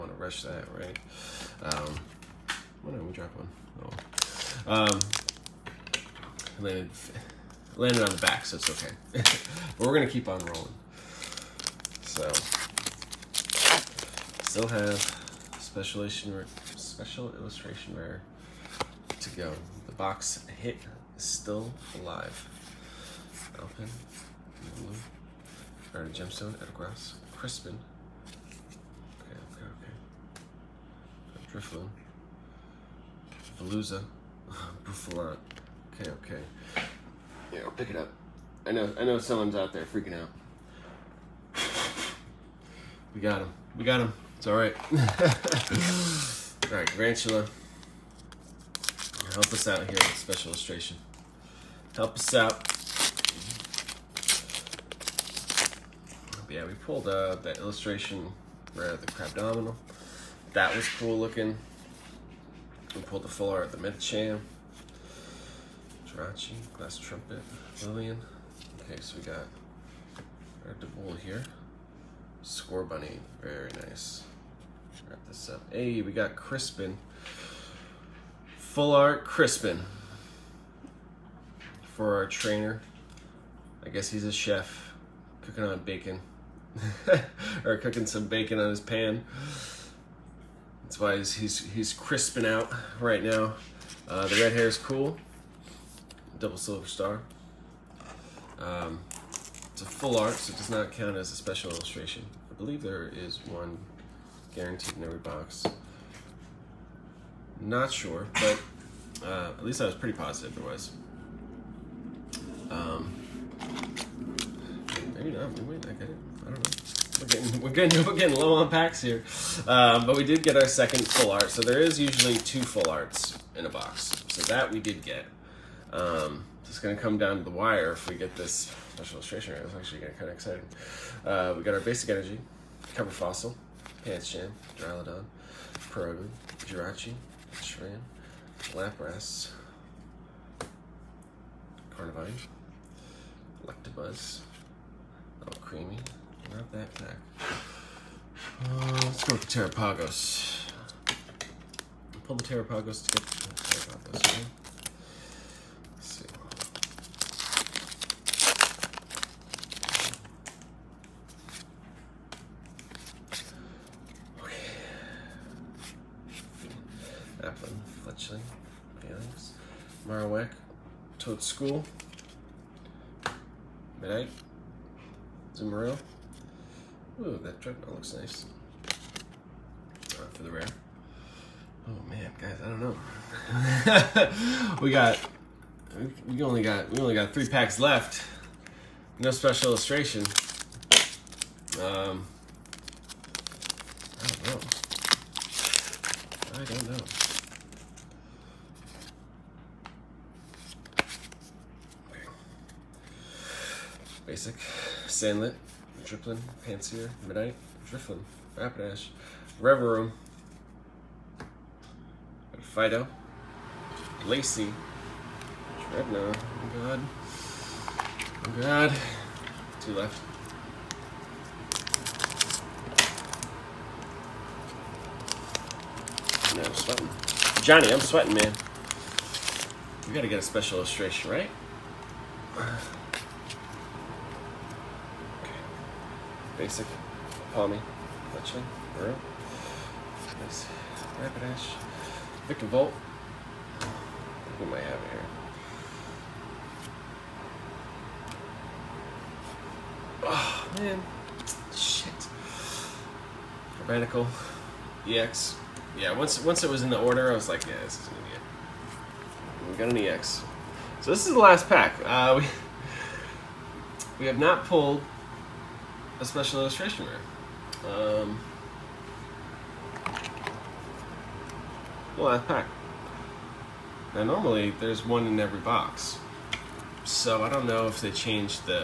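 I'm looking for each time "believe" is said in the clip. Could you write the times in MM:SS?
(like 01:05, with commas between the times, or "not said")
01:42.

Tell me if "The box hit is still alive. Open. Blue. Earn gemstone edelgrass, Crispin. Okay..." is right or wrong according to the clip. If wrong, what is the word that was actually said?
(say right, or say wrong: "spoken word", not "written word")
right.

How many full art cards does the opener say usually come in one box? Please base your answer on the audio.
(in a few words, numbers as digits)
2.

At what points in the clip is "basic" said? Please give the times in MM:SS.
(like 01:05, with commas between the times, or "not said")
02:11, 03:24, 03:56.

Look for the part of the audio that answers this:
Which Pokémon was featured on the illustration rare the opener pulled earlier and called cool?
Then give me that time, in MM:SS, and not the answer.
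00:59.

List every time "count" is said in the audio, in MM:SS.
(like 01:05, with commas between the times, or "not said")
01:40.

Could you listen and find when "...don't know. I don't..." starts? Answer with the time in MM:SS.
03:14.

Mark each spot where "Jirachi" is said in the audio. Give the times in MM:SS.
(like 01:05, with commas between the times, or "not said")
01:06, 02:16.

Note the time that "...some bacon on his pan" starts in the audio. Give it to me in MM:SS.
01:28.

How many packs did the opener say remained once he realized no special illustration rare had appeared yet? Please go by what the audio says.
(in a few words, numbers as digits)
3.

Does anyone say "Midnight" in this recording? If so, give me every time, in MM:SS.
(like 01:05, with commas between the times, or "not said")
02:54, 03:27.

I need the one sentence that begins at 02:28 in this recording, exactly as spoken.
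Uh, let's go with the Terapagos.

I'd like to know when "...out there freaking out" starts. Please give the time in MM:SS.
00:39.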